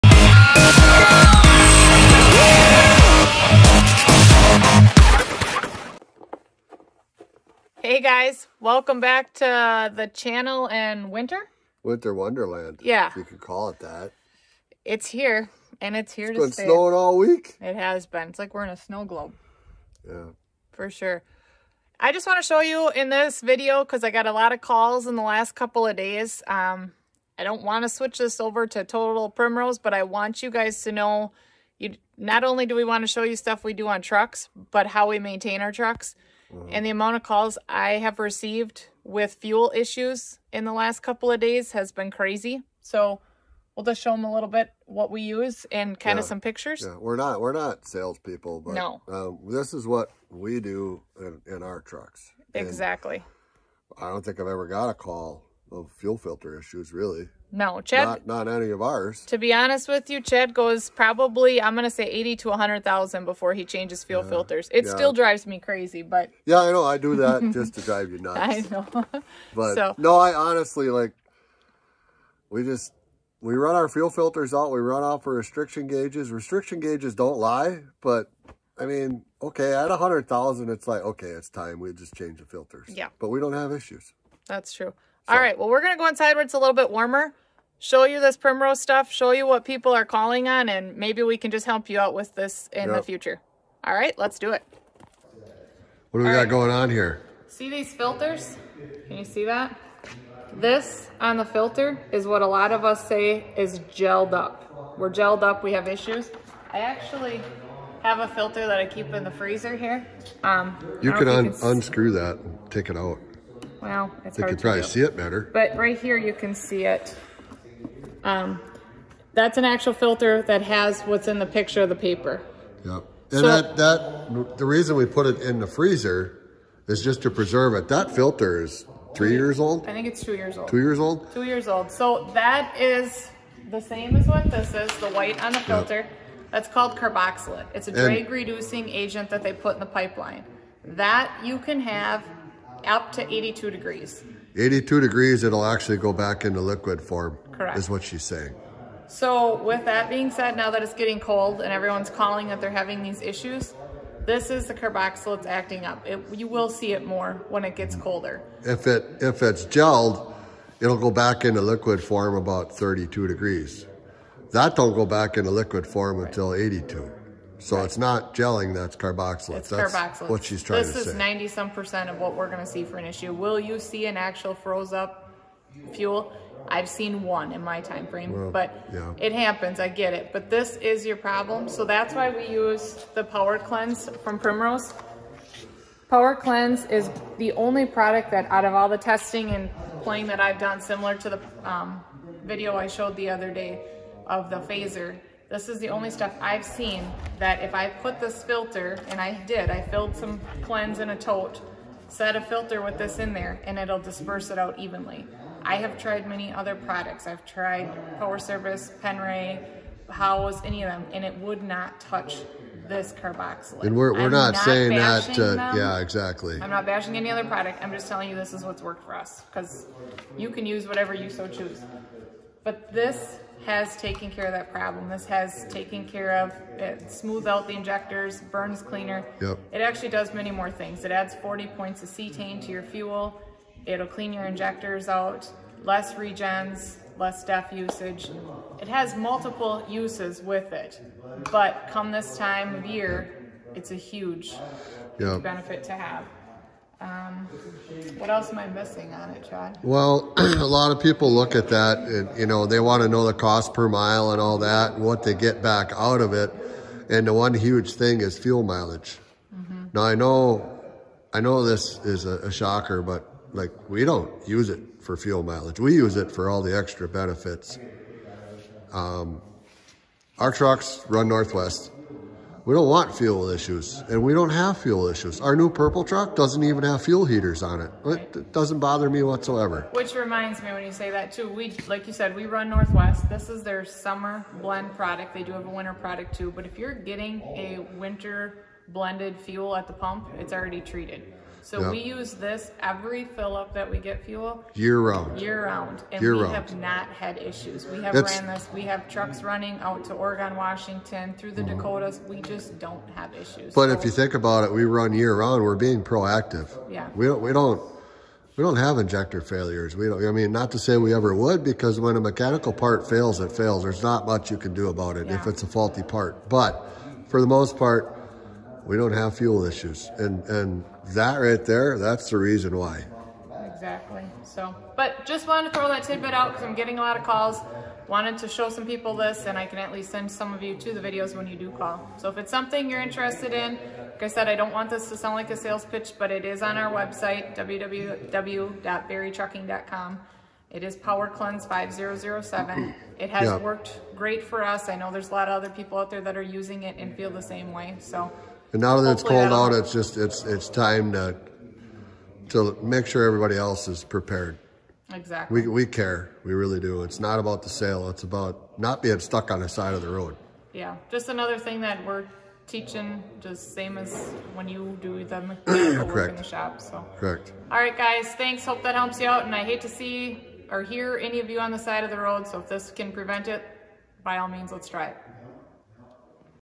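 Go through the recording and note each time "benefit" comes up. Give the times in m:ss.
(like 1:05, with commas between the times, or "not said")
4:05, 4:27.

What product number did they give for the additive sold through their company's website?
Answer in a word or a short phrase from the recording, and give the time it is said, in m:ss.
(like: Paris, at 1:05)
5007, at 5:41.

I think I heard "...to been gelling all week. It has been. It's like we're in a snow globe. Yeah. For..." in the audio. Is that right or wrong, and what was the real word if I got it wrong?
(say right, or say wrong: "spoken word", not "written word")
wrong: "snowing", not "gelling".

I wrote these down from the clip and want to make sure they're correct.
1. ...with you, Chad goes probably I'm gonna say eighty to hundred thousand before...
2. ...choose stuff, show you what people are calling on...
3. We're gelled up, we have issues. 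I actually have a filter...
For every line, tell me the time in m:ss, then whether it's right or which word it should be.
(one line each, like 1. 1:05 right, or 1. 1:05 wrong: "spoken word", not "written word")
1. 0:59 right
2. 1:28 wrong: "primrose", not "choose"
3. 1:44 right.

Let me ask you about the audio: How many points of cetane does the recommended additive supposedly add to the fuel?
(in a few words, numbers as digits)
40.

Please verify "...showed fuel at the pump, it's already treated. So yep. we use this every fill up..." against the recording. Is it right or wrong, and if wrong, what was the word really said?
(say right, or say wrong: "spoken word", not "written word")
wrong: "blended", not "showed".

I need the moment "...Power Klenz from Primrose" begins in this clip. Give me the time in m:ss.
3:03.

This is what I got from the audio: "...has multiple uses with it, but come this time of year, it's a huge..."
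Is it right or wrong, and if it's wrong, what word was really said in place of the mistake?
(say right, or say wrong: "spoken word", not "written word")
right.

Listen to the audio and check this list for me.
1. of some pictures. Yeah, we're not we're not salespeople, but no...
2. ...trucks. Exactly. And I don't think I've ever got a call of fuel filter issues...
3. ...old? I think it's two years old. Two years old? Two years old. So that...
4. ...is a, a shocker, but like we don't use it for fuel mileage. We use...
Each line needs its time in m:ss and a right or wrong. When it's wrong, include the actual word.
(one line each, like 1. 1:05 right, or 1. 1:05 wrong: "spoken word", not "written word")
1. 0:46 right
2. 0:51 right
3. 2:09 right
4. 4:22 right.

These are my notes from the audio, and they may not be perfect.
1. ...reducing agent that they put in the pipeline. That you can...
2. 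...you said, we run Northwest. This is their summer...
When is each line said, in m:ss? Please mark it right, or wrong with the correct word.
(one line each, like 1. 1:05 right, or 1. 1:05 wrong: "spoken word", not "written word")
1. 2:18 right
2. 4:42 right.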